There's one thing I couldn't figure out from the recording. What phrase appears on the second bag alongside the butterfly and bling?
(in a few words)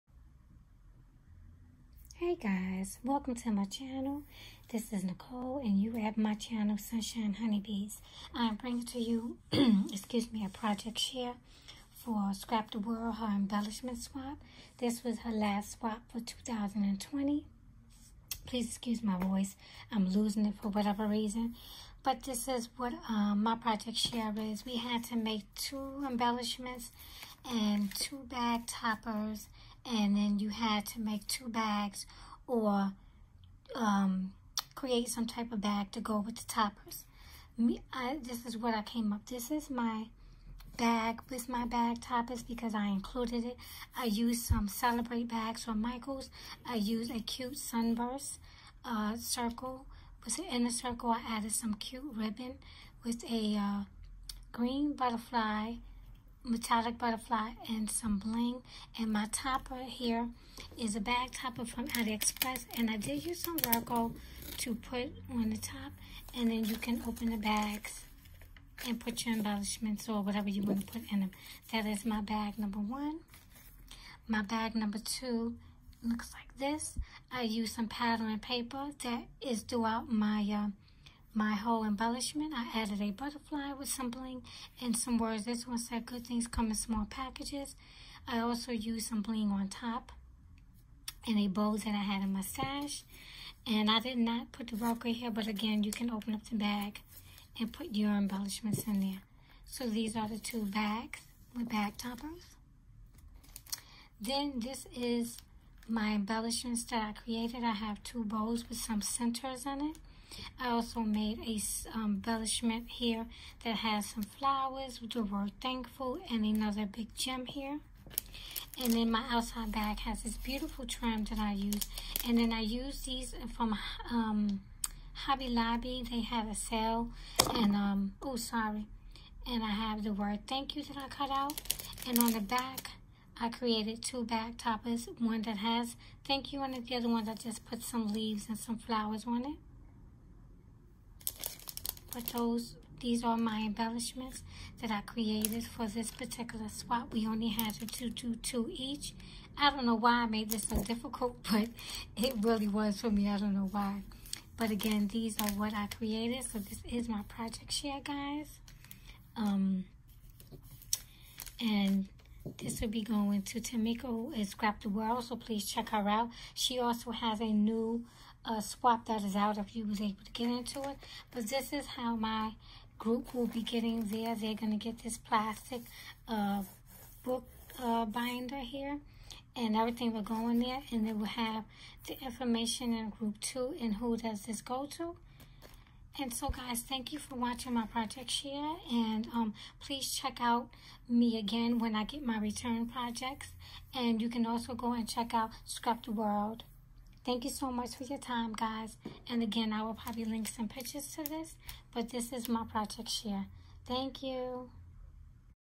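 Good things come in small packages.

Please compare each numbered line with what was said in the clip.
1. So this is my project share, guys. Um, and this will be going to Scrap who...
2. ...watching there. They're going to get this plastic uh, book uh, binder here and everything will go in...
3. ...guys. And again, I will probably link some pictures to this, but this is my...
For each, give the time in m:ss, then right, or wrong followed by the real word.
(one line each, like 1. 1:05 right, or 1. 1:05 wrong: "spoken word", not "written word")
1. 2:36 wrong: "Tamiko", not "Scrap"
2. 2:53 wrong: "getting", not "watching"
3. 3:18 right.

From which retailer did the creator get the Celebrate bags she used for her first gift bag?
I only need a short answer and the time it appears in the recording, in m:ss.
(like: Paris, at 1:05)
Michaels, at 0:45.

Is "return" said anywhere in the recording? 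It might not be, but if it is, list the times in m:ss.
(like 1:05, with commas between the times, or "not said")
3:12.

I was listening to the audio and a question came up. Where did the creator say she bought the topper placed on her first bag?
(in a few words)
AliExpress.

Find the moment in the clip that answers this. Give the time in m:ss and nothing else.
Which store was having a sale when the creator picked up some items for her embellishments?
2:05.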